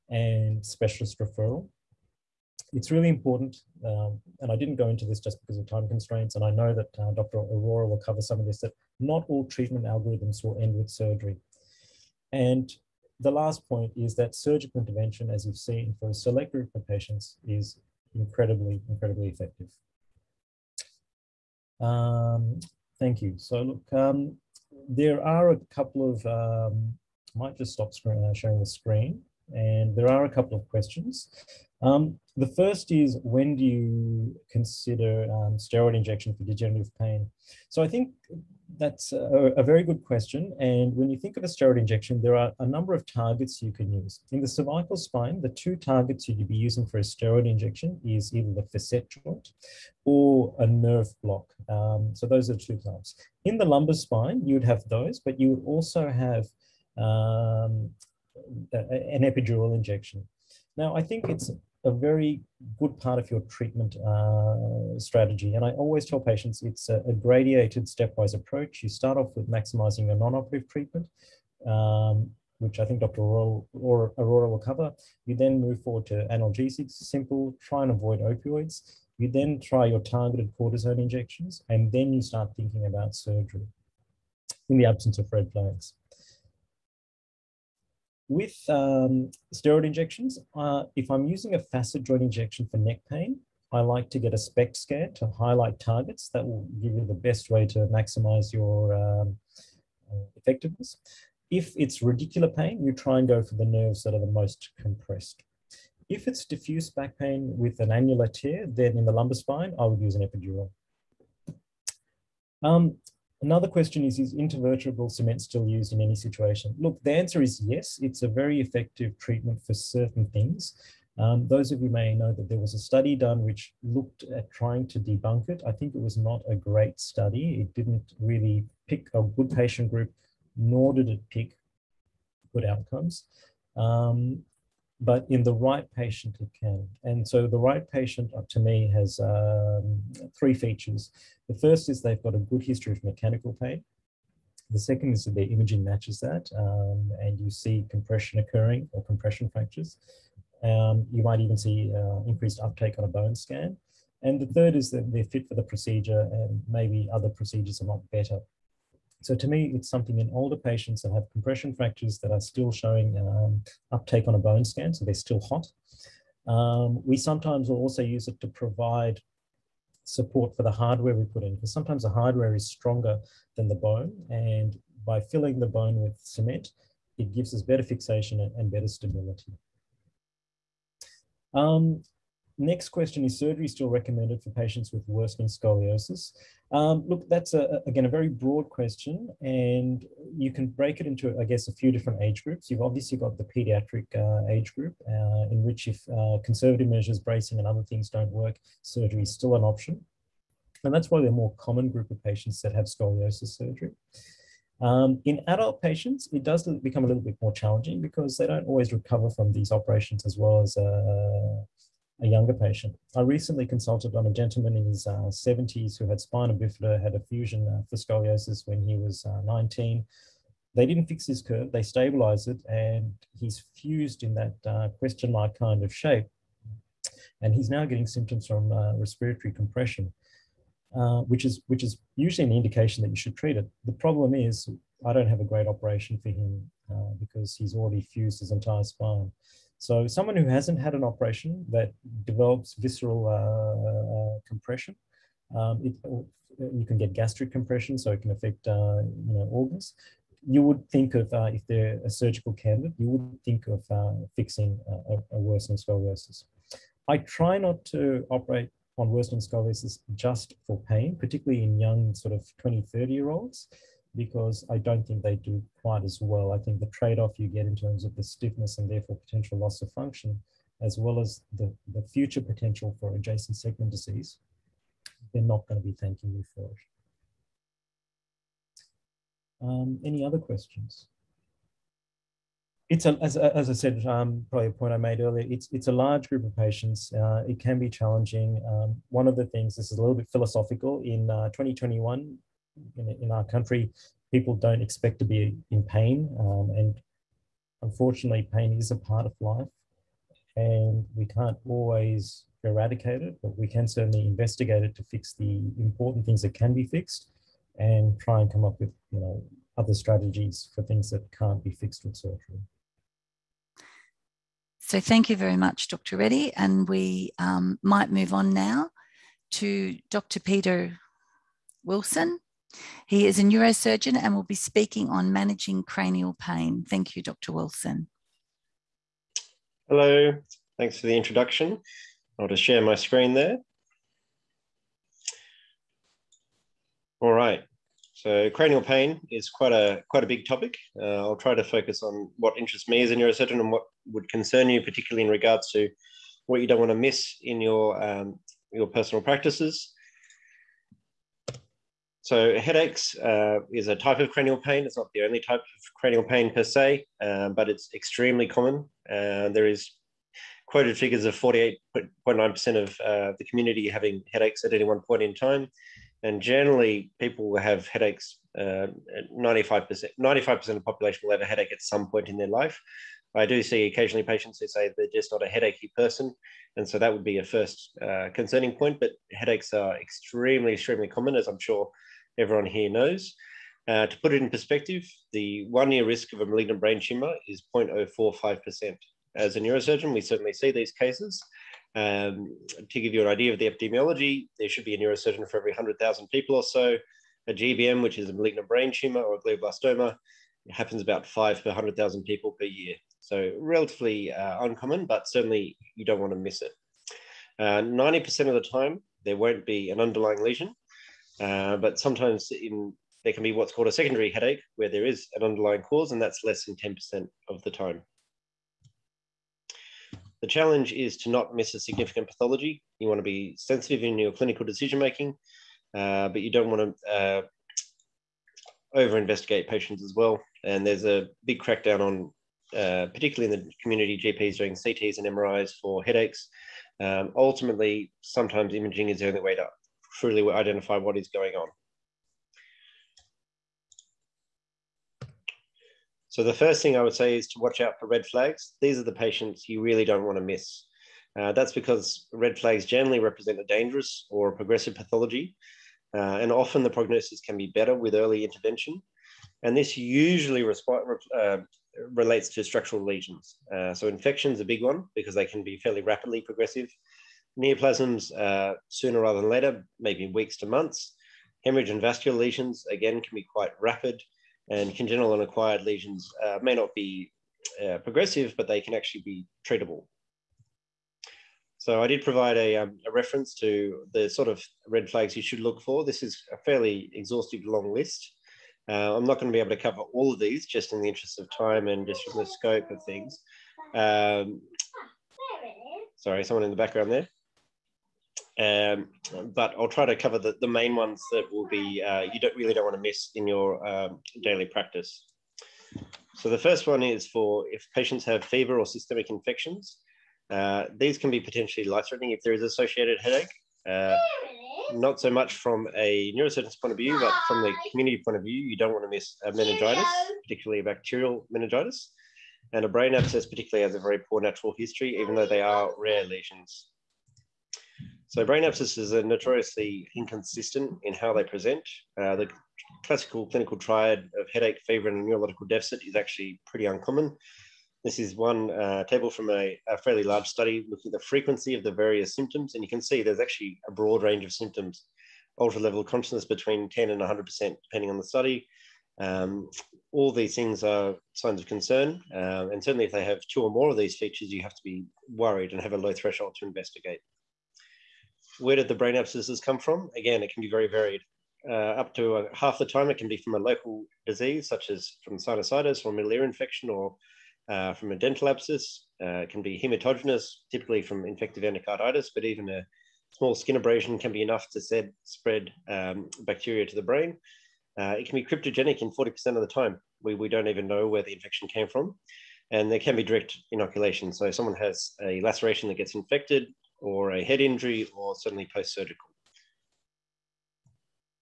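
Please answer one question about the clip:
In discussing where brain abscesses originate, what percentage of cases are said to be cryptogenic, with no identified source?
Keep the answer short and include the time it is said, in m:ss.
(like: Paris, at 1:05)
40%, at 9:39.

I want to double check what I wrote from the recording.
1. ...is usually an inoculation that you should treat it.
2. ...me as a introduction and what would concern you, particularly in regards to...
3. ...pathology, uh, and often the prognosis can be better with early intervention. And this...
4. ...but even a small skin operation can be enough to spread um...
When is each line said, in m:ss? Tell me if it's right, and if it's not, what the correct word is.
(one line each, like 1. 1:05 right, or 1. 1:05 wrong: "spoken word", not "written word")
1. 3:51 wrong: "indication", not "inoculation"
2. 5:42 wrong: "neurosurgeon", not "introduction"
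3. 7:34 right
4. 9:32 wrong: "abrasion", not "operation".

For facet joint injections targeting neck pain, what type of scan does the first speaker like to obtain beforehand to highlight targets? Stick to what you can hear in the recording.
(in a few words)
SPECT scan.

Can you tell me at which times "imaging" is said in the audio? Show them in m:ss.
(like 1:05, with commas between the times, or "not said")
2:25, 7:18.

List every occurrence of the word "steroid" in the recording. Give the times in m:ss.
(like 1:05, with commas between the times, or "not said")
0:35, 0:41, 0:47, 1:29.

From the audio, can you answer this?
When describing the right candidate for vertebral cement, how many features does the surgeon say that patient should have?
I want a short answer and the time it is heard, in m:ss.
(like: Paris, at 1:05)
3, at 2:20.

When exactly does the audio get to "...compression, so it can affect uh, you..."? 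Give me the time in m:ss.
4:07.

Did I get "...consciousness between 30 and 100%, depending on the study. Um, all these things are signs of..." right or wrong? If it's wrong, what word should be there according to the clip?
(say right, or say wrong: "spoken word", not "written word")
wrong: "10", not "30".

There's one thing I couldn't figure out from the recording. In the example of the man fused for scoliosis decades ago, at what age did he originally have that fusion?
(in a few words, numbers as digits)
19.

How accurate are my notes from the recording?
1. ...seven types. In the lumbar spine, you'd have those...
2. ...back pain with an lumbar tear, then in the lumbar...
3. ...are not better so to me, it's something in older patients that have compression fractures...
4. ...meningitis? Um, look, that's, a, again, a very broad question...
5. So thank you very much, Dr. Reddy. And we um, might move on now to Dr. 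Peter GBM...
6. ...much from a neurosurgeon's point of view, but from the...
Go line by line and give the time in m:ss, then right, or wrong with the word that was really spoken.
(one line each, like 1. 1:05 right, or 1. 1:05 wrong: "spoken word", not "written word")
1. 0:52 wrong: "two", not "seven"
2. 1:46 wrong: "annular", not "lumbar"
3. 2:37 right
4. 3:05 wrong: "scoliosis", not "meningitis"
5. 5:14 wrong: "Wilson", not "GBM"
6. 8:35 right.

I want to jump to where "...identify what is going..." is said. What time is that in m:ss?
7:20.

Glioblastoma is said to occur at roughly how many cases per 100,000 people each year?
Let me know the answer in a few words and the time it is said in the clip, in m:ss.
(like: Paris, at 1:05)
5, at 6:41.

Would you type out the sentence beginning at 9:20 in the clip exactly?
Again, it can be very varied.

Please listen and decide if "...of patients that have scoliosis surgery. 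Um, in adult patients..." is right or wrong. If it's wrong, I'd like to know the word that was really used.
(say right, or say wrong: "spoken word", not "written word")
right.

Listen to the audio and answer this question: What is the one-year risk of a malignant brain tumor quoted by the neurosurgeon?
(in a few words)
0.045%.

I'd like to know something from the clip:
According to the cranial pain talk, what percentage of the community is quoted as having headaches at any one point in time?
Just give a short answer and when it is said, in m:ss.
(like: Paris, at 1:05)
48.9%, at 6:01.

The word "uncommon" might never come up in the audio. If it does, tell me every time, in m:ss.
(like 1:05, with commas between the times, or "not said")
6:44, 8:56.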